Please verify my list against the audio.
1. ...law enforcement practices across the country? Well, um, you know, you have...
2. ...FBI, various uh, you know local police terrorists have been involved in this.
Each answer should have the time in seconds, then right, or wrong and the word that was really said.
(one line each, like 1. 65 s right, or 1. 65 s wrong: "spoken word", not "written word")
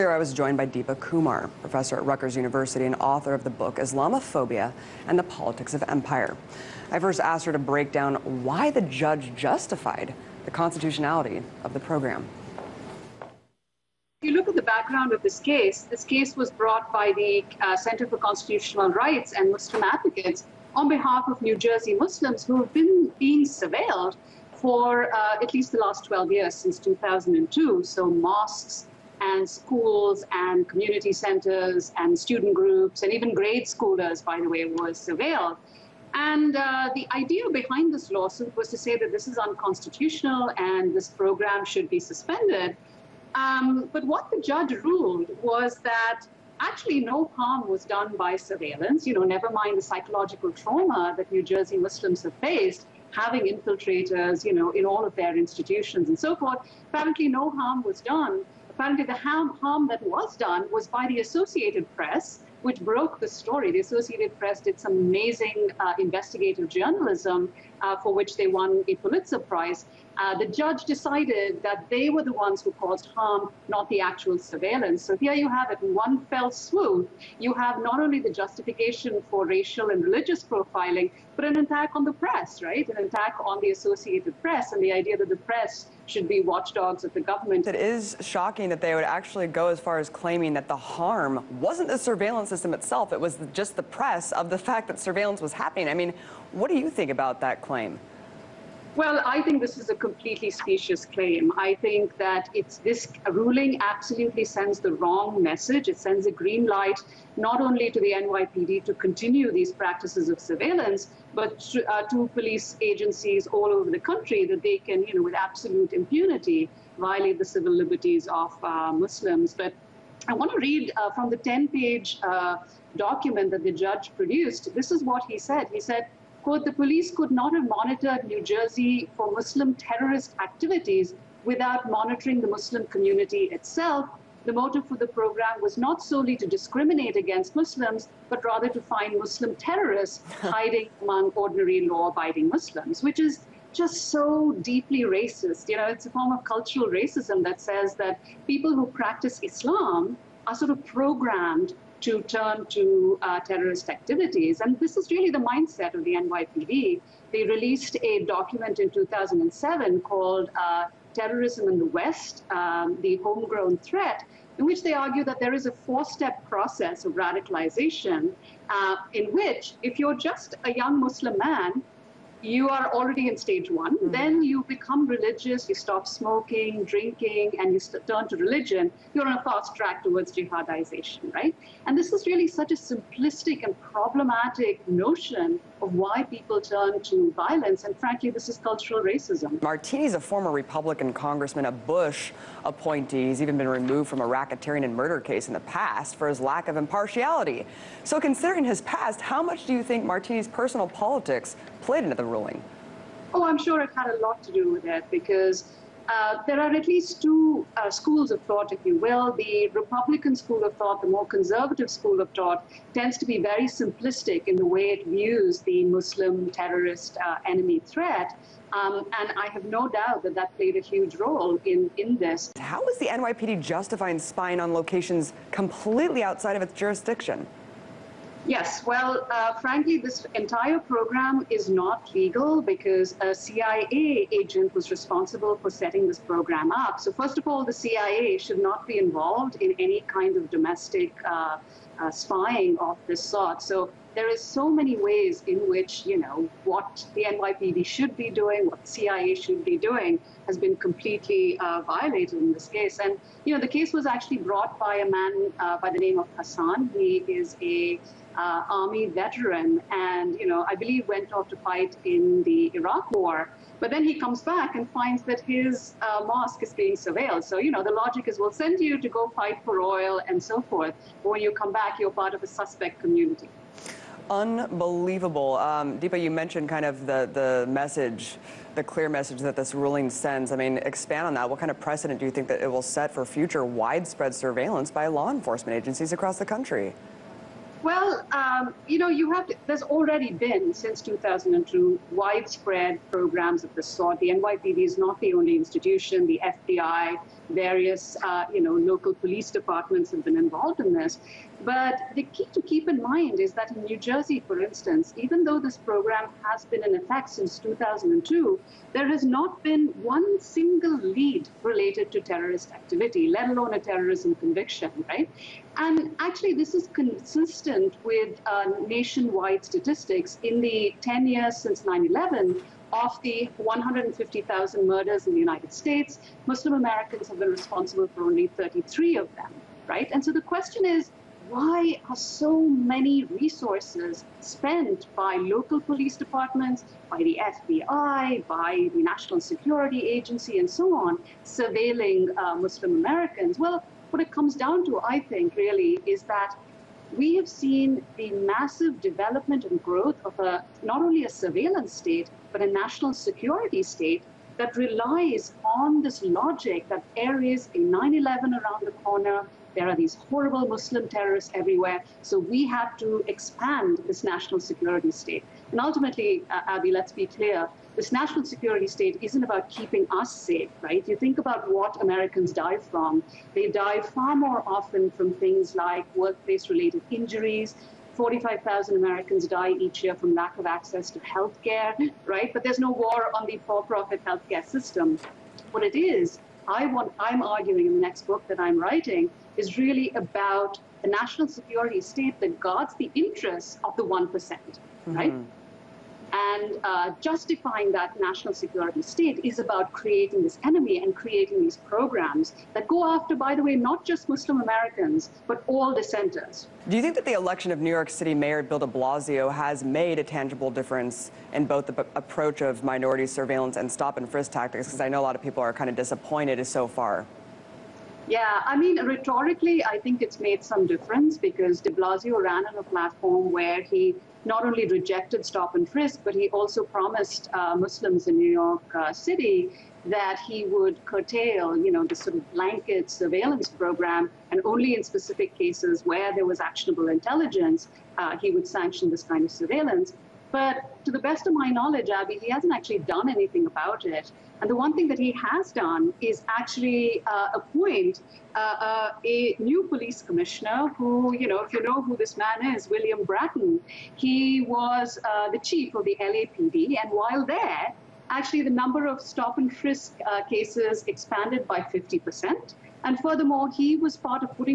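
1. 285 s wrong: "agencies", not "practices"
2. 296 s wrong: "departments", not "terrorists".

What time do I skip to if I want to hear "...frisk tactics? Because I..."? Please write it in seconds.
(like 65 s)
414 s.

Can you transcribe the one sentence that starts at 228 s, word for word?
Yes, well, uh, frankly, this entire program is not legal because a CIA agent was responsible for setting this program up.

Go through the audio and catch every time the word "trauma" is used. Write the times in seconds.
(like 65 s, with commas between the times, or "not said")
50 s.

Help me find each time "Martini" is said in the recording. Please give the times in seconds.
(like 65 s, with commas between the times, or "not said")
189 s, 200 s.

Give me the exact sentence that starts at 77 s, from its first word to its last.
You have not only the justification for racial and religious profiling, but an attack on the press, right?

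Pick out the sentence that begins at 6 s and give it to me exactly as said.
I first asked her to break down why the judge justified the constitutionality of the program.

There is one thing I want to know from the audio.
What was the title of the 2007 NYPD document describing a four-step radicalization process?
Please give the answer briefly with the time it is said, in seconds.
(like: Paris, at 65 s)
Terrorism in the West, at 161 s.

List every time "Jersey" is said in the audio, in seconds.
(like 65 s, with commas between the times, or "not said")
21 s, 51 s, 128 s, 303 s.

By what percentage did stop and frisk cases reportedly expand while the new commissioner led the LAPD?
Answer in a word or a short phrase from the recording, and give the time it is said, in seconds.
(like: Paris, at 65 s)
50 percent, at 461 s.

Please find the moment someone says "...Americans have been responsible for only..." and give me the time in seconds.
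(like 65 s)
326 s.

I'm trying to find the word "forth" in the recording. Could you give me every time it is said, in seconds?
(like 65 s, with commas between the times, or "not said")
56 s, 270 s.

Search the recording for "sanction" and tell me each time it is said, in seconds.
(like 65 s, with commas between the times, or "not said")
438 s.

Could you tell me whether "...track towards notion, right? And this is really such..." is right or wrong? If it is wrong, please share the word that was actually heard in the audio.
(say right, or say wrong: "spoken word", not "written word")
wrong: "jihadization", not "notion".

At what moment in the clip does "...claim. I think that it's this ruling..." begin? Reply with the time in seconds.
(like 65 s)
101 s.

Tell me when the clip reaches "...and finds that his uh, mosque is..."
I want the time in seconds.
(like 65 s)
264 s.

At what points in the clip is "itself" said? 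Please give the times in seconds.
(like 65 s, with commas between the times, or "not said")
92 s, 133 s.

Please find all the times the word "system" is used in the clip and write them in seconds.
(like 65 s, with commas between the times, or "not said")
92 s, 384 s.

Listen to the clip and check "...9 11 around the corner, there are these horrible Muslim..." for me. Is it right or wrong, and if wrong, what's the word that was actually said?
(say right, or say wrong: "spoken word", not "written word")
right.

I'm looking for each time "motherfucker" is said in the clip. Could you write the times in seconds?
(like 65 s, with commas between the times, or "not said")
not said.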